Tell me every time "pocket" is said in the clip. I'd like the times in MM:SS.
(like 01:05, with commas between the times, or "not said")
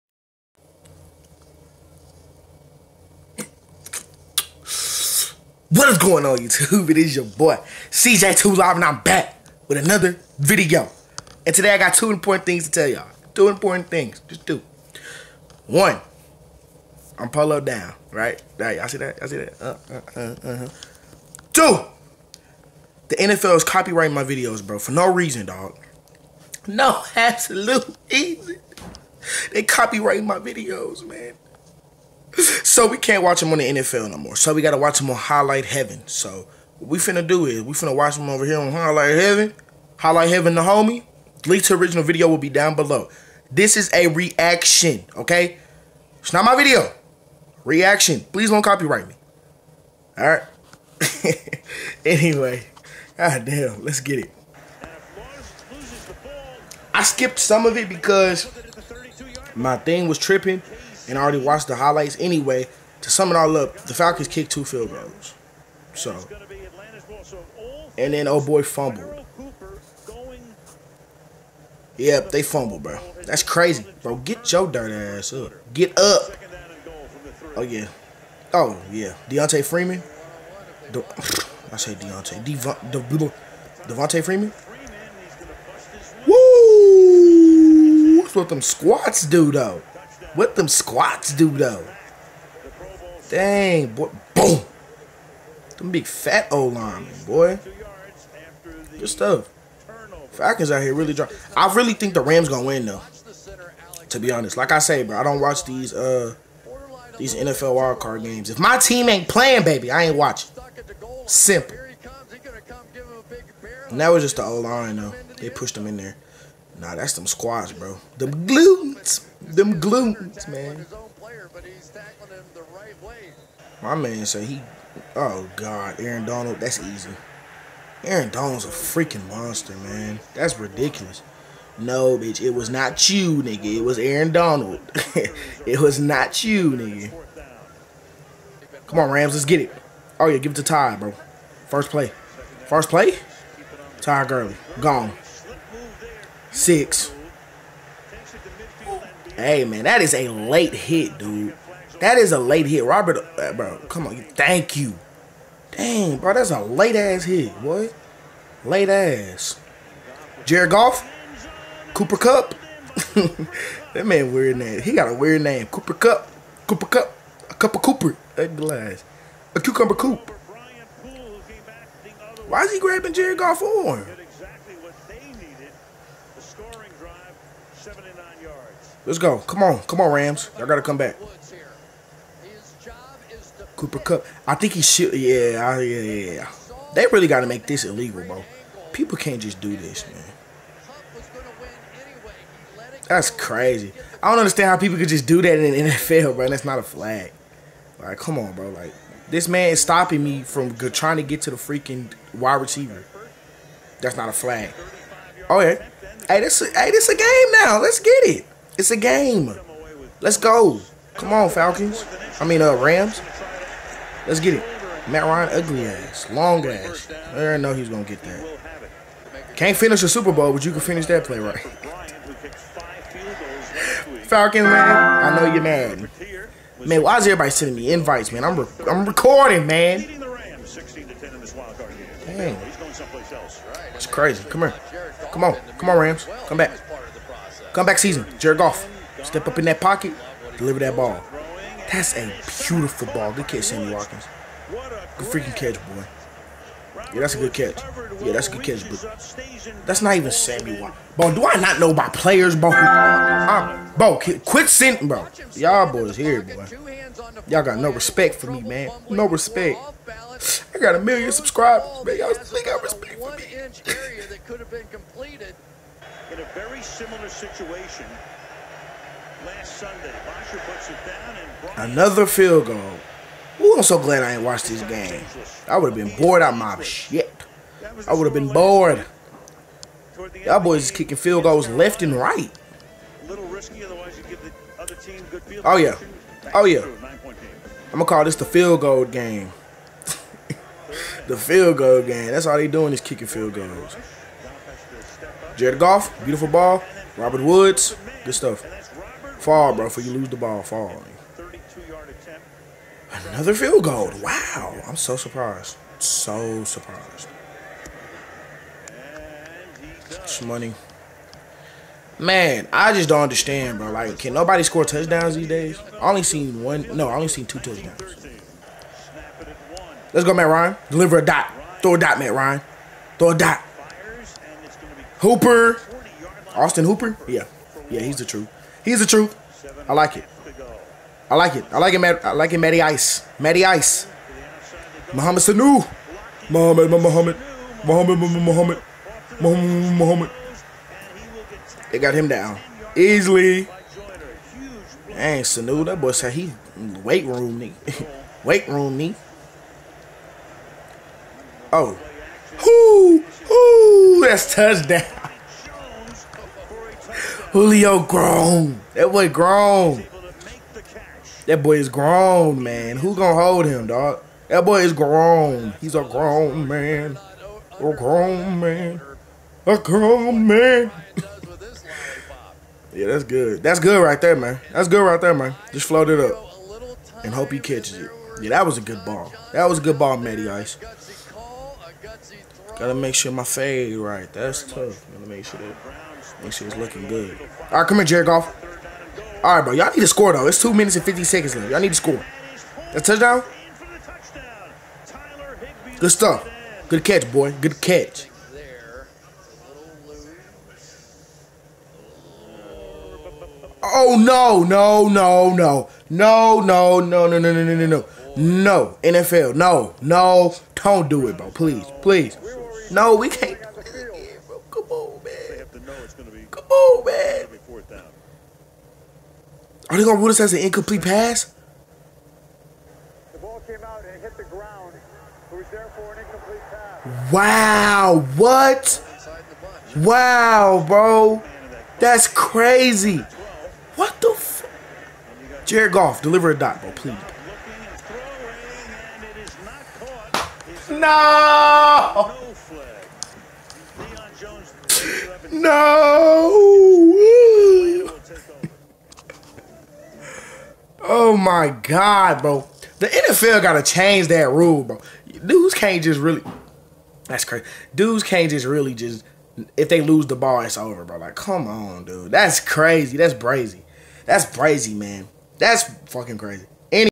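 03:59.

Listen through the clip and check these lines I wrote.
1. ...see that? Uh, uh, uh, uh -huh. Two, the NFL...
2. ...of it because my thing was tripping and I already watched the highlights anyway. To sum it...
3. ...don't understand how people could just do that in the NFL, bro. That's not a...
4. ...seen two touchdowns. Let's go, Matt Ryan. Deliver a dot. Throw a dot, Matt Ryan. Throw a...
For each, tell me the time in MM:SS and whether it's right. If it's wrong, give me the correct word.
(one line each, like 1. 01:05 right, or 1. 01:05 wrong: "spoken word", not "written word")
1. 00:19 right
2. 00:57 right
3. 03:14 right
4. 05:17 right.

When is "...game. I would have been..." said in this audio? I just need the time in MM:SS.
04:34.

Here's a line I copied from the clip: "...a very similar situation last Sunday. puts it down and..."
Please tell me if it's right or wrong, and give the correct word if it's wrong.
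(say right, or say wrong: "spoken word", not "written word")
right.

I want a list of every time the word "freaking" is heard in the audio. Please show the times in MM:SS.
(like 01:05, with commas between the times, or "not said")
02:08, 03:21, 04:05.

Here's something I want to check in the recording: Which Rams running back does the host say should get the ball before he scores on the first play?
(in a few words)
Ty Gurley.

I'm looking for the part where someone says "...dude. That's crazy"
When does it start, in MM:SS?
07:42.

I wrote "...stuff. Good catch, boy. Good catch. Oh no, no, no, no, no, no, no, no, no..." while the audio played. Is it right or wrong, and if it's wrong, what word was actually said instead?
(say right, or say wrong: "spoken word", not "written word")
right.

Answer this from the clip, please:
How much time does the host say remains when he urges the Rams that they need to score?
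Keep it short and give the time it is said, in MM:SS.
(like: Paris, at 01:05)
2 minutes 50 seconds, at 06:30.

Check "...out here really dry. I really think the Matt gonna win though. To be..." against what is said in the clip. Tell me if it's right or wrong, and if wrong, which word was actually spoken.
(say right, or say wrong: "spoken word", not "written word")
wrong: "Rams", not "Matt".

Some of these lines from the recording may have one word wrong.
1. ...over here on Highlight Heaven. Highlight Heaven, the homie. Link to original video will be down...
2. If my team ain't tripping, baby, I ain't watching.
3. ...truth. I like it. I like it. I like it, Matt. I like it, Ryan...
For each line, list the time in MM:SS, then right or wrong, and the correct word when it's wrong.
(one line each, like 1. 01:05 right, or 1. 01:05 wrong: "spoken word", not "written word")
1. 00:38 right
2. 01:48 wrong: "playing", not "tripping"
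3. 05:29 wrong: "Matty", not "Ryan".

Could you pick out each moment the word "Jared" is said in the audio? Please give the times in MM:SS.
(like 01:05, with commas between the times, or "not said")
02:40, 02:53, 03:58, 04:55, 06:28, 07:15.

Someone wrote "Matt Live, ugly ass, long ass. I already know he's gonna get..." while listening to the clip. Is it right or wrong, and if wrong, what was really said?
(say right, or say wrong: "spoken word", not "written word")
wrong: "Ryan", not "Live".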